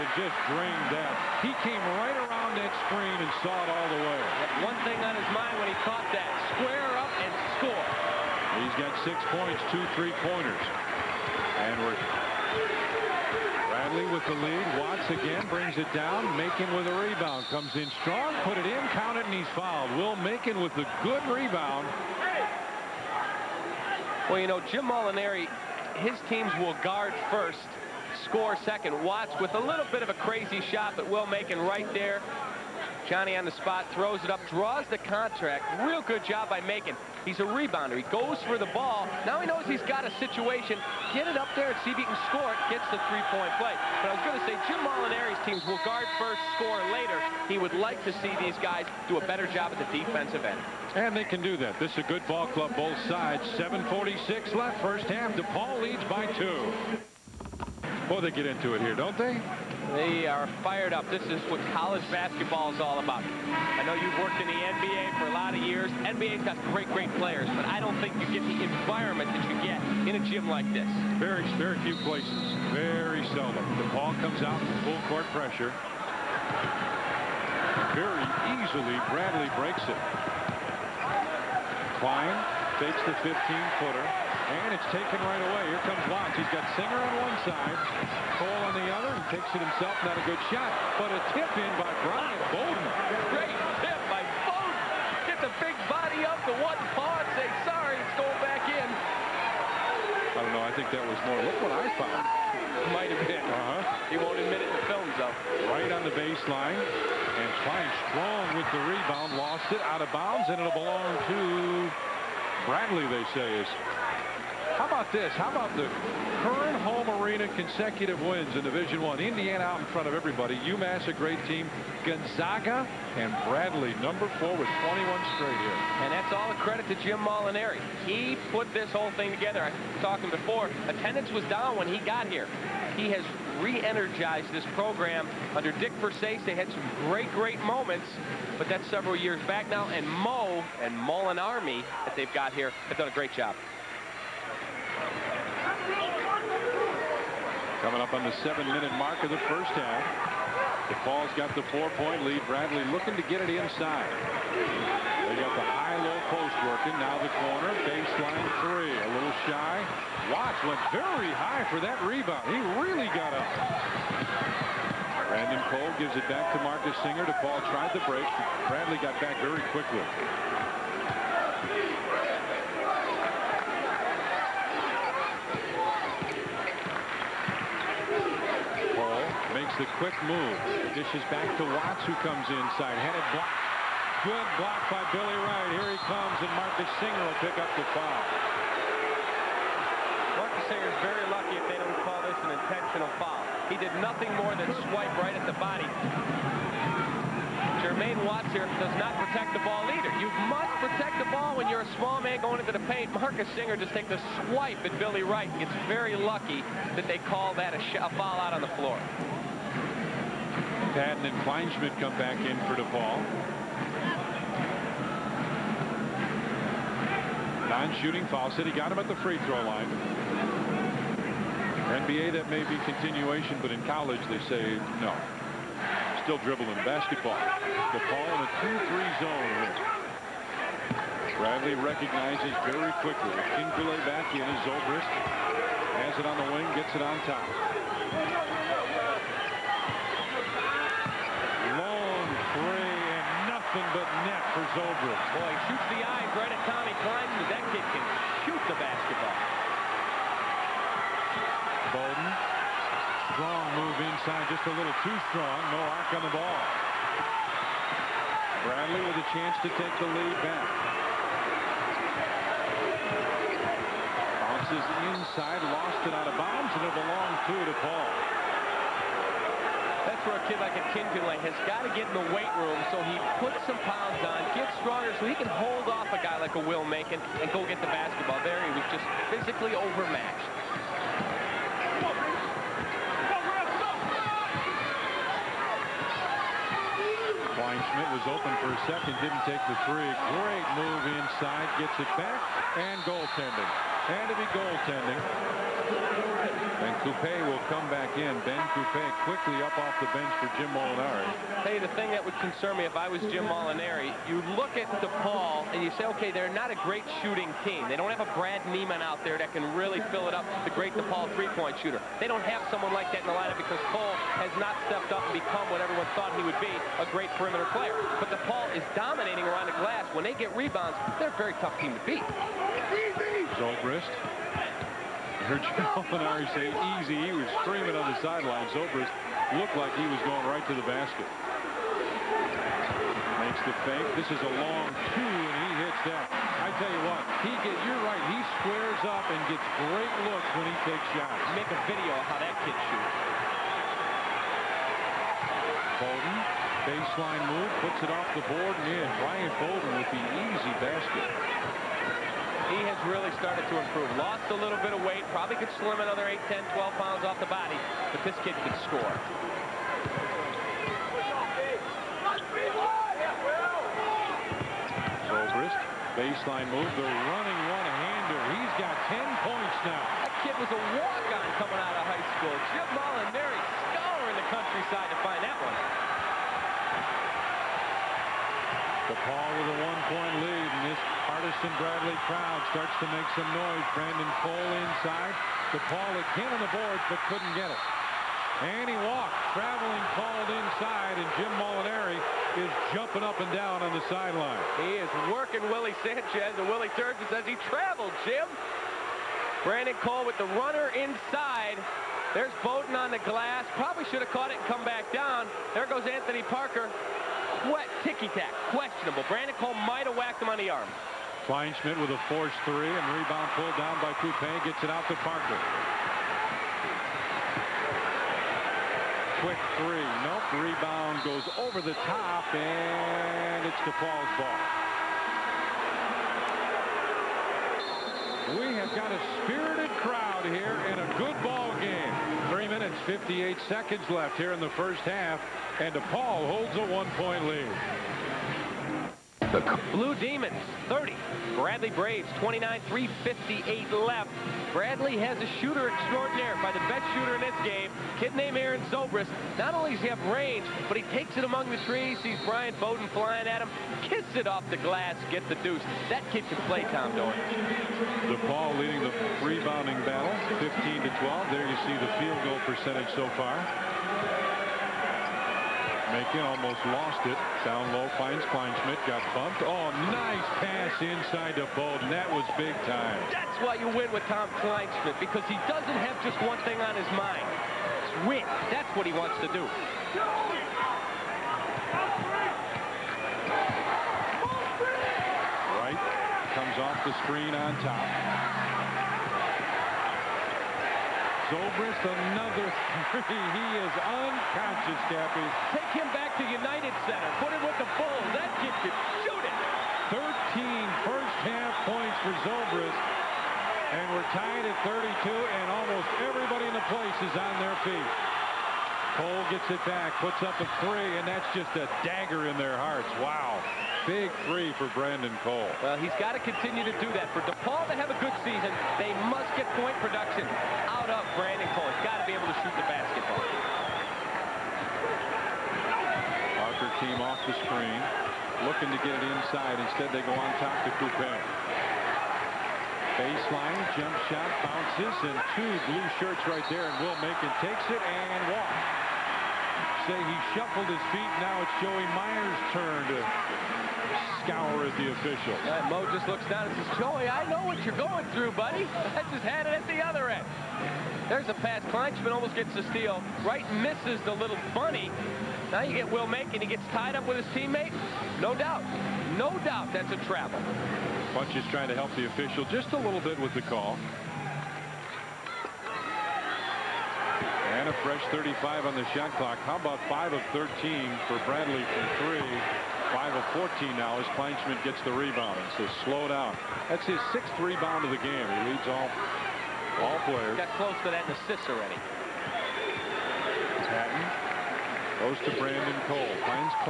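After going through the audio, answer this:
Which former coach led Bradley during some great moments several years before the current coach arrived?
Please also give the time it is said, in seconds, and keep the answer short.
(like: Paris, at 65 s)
Dick Versace, at 135 s.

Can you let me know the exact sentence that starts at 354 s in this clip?
Lost a little bit of weight, probably could slim another 8, 10, 12 pounds off the body, but this kid can score.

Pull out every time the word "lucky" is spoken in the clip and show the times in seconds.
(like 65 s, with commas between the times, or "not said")
191 s, 206 s.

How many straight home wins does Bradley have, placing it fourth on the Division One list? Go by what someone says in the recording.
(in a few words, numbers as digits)
21.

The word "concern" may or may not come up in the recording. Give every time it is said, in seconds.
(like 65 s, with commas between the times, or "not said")
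302 s.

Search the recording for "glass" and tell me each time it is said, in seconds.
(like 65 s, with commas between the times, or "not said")
319 s, 403 s, 454 s.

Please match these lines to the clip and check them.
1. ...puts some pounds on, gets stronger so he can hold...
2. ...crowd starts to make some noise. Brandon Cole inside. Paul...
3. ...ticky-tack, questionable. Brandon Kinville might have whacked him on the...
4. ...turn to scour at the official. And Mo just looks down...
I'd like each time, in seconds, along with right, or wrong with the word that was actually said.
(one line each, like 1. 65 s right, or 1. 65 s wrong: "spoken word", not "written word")
1. 273 s right
2. 382 s right
3. 408 s wrong: "Cole", not "Kinville"
4. 542 s right.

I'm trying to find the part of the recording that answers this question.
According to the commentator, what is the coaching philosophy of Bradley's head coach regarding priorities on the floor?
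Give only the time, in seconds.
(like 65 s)
26 s.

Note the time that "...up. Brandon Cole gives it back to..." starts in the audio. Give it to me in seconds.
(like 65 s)
163 s.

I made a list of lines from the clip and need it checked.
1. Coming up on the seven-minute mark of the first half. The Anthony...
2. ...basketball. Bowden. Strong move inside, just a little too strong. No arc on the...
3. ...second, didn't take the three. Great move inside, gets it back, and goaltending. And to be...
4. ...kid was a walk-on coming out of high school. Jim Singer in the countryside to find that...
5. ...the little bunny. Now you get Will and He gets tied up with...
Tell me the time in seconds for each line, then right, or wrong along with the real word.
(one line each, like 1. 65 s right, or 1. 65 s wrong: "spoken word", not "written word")
1. 147 s wrong: "Falls", not "Anthony"
2. 248 s right
3. 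288 s right
4. 370 s wrong: "Molinari", not "Singer"
5. 554 s right.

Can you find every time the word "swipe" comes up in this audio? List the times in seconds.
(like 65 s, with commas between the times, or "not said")
194 s, 204 s.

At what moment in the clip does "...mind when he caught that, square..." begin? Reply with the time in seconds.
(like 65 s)
5 s.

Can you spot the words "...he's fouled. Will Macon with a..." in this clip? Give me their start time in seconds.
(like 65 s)
19 s.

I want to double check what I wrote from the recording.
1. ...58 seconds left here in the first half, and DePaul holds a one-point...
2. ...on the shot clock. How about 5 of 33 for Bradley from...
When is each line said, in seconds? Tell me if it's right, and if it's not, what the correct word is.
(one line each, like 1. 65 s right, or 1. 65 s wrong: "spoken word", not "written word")
1. 433 s right
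2. 568 s wrong: "13", not "33".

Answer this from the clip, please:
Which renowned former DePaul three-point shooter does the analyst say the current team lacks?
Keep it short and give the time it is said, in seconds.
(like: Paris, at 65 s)
Brad Neiman, at 308 s.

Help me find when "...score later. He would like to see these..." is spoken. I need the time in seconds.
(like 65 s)
46 s.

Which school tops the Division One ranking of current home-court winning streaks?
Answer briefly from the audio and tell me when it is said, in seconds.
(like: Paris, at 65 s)
Indiana, at 119 s.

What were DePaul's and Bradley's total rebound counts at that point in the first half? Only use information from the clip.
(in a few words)
15 to 12.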